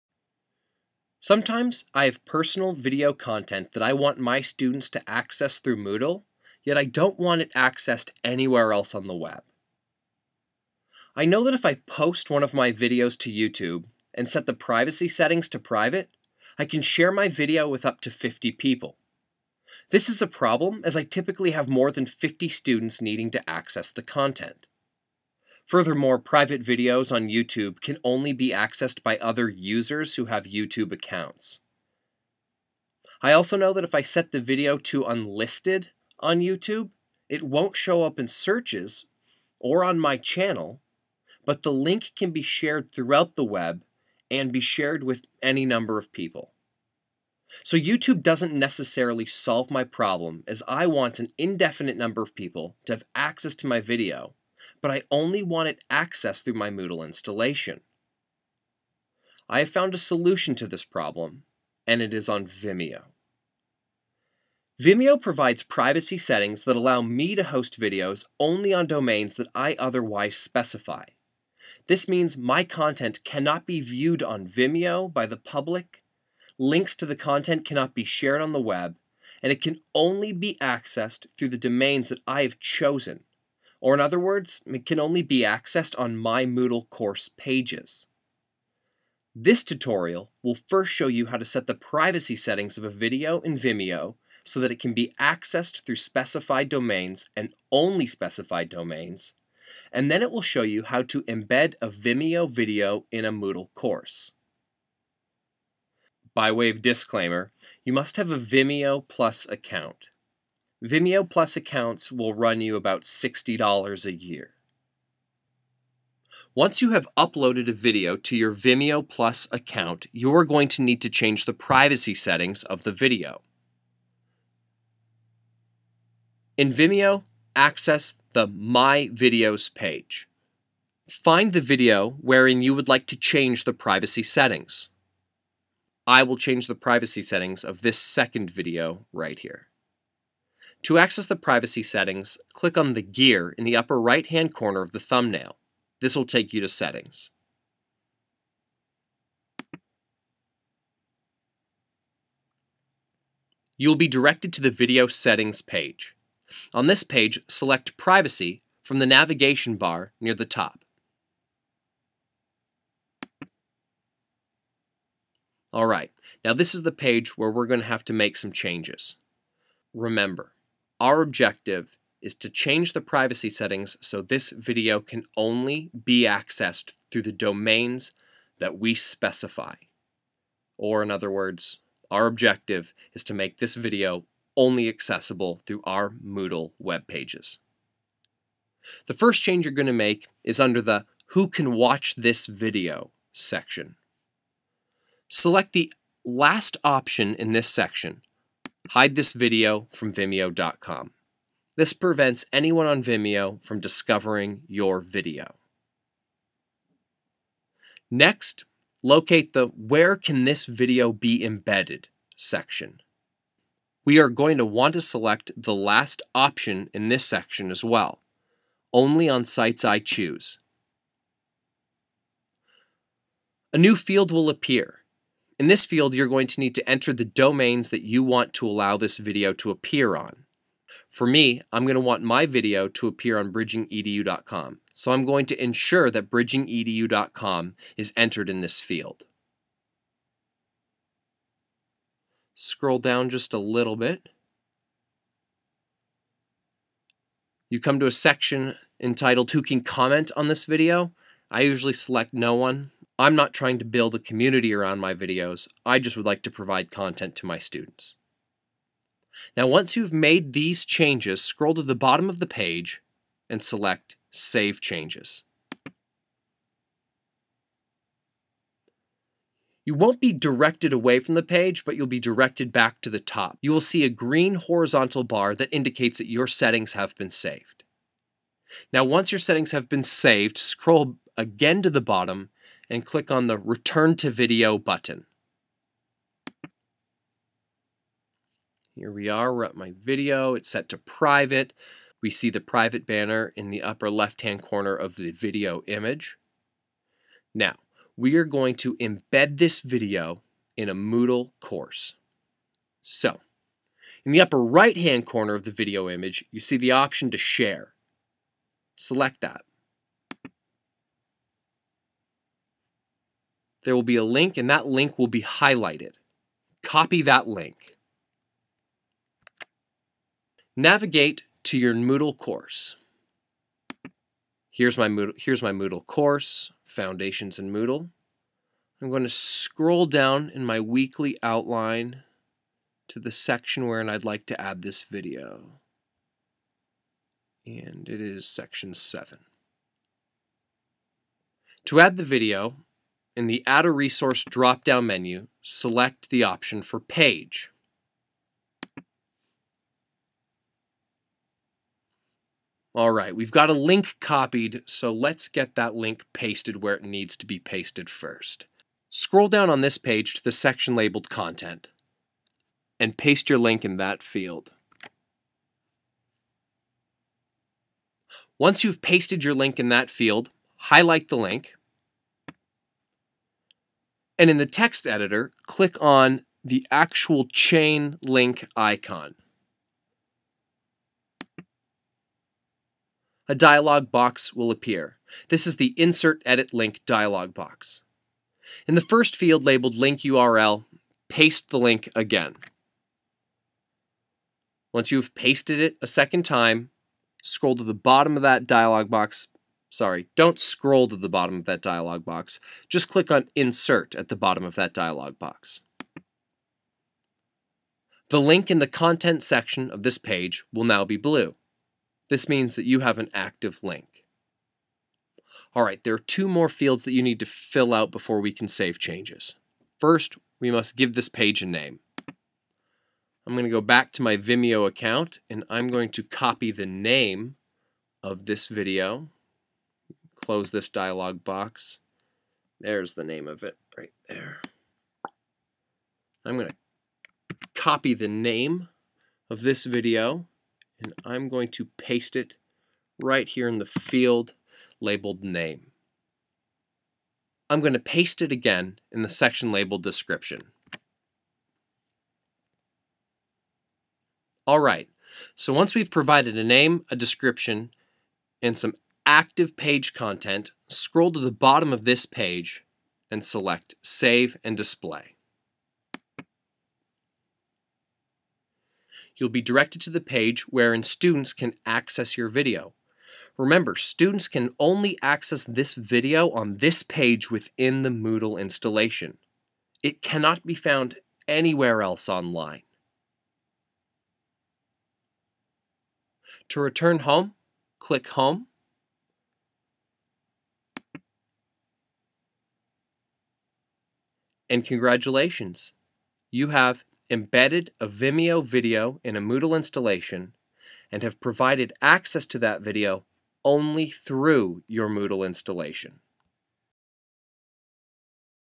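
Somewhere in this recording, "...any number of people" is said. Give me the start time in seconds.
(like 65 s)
45 s.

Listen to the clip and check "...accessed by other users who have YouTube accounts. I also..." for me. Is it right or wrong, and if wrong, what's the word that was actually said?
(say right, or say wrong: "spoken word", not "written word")
right.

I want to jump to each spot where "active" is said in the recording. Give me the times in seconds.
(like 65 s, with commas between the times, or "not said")
413 s, 459 s.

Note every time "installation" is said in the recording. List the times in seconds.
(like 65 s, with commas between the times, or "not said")
57 s, 478 s, 499 s, 505 s.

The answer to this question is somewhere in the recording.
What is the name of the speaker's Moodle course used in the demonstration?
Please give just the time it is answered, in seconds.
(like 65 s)
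326 s.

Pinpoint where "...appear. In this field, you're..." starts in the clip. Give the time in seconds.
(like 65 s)
224 s.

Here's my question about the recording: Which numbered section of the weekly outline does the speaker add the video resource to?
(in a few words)
7.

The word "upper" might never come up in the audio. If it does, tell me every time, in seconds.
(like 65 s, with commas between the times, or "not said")
143 s, 293 s, 304 s.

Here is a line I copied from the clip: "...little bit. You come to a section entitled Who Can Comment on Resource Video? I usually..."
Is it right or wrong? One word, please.
wrong.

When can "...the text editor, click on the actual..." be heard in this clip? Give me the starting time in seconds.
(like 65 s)
374 s.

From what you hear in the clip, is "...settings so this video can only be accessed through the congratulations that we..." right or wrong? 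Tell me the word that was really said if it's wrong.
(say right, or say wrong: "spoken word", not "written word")
wrong: "domains", not "congratulations".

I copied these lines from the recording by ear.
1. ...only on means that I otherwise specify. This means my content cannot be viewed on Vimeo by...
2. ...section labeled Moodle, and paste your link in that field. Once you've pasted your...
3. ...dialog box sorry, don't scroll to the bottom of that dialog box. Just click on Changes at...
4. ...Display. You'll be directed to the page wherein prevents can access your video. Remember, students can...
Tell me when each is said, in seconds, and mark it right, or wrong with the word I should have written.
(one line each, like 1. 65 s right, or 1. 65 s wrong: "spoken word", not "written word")
1. 68 s wrong: "domains", not "means"
2. 360 s wrong: "Content", not "Moodle"
3. 398 s wrong: "Insert", not "Changes"
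4. 464 s wrong: "students", not "prevents".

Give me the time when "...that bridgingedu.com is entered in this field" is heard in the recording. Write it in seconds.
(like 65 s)
236 s.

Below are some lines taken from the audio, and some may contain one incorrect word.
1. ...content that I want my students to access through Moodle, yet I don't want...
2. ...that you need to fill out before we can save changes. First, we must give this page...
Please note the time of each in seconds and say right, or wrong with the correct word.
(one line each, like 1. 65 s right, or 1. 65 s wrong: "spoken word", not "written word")
1. 3 s right
2. 417 s right.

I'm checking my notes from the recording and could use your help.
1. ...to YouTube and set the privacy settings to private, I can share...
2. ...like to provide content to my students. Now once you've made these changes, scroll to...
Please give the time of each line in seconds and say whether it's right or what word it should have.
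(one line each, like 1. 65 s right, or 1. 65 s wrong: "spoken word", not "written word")
1. 13 s right
2. 256 s right.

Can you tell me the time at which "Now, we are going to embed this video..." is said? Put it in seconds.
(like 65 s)
297 s.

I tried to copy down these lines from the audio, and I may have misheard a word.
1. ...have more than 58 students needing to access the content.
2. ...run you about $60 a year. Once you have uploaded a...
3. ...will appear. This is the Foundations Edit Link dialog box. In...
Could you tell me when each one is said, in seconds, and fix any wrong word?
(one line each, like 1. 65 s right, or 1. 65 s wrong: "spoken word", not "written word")
1. 21 s wrong: "50", not "58"
2. 112 s right
3. 384 s wrong: "Insert", not "Foundations".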